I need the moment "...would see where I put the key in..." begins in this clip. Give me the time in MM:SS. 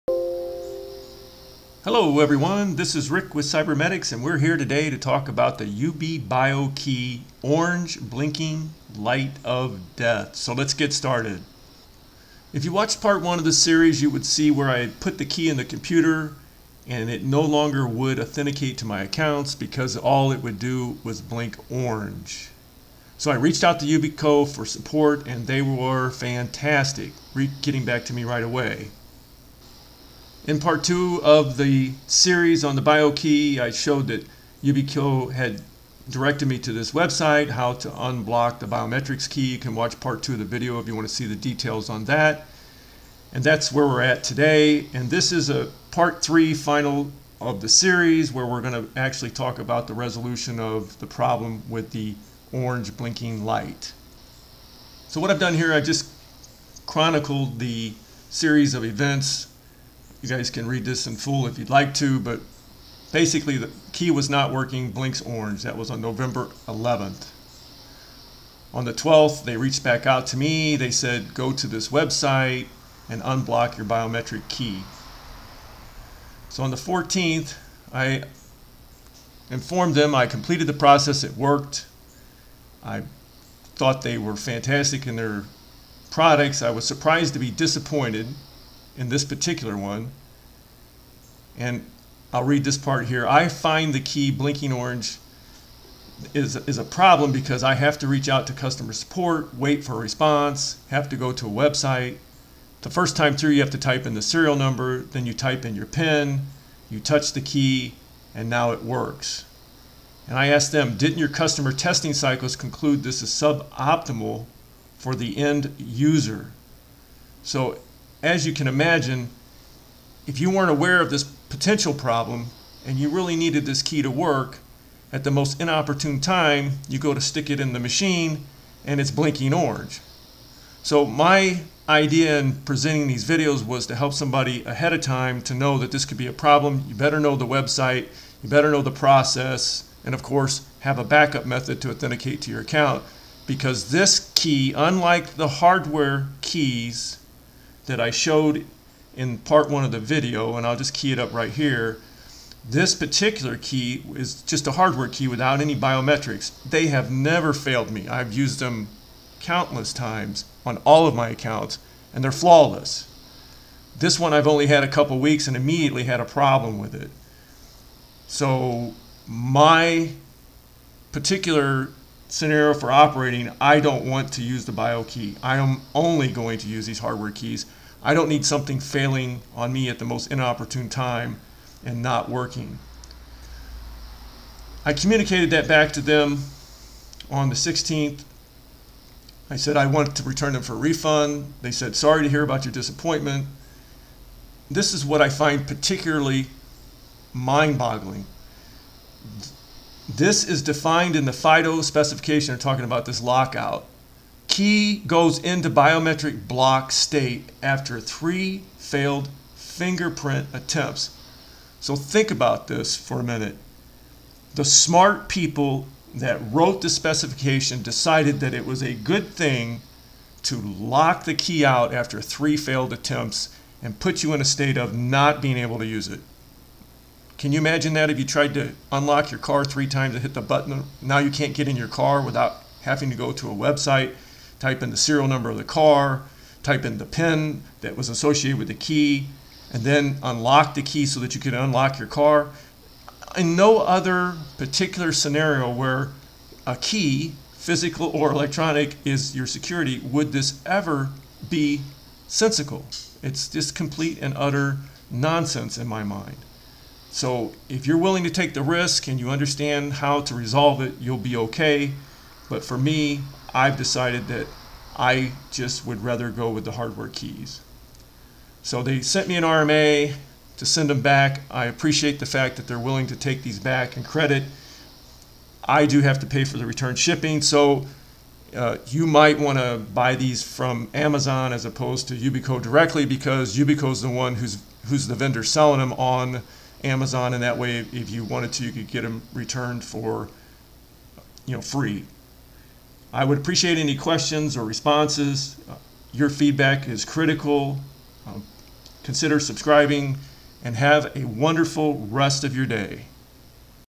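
00:14.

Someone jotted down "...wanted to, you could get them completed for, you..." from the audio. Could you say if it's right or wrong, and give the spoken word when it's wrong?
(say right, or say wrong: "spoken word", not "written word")
wrong: "returned", not "completed".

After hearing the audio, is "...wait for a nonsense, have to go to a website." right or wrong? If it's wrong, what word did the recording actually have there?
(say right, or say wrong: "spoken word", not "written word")
wrong: "response", not "nonsense".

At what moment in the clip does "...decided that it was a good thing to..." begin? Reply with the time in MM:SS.
03:37.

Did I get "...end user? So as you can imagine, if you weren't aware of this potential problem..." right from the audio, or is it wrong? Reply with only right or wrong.
right.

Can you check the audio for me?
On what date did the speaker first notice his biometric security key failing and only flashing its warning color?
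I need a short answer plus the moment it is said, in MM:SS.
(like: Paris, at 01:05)
November 11, at 01:05.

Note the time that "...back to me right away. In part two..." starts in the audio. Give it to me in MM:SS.
00:27.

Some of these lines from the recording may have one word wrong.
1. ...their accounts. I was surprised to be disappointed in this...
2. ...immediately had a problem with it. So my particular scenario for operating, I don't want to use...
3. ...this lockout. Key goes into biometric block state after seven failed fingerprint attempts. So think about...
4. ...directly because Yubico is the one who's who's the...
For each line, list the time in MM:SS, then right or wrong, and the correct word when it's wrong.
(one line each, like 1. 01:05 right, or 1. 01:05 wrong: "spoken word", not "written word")
1. 01:25 wrong: "products", not "accounts"
2. 02:45 right
3. 03:23 wrong: "three", not "seven"
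4. 04:42 right.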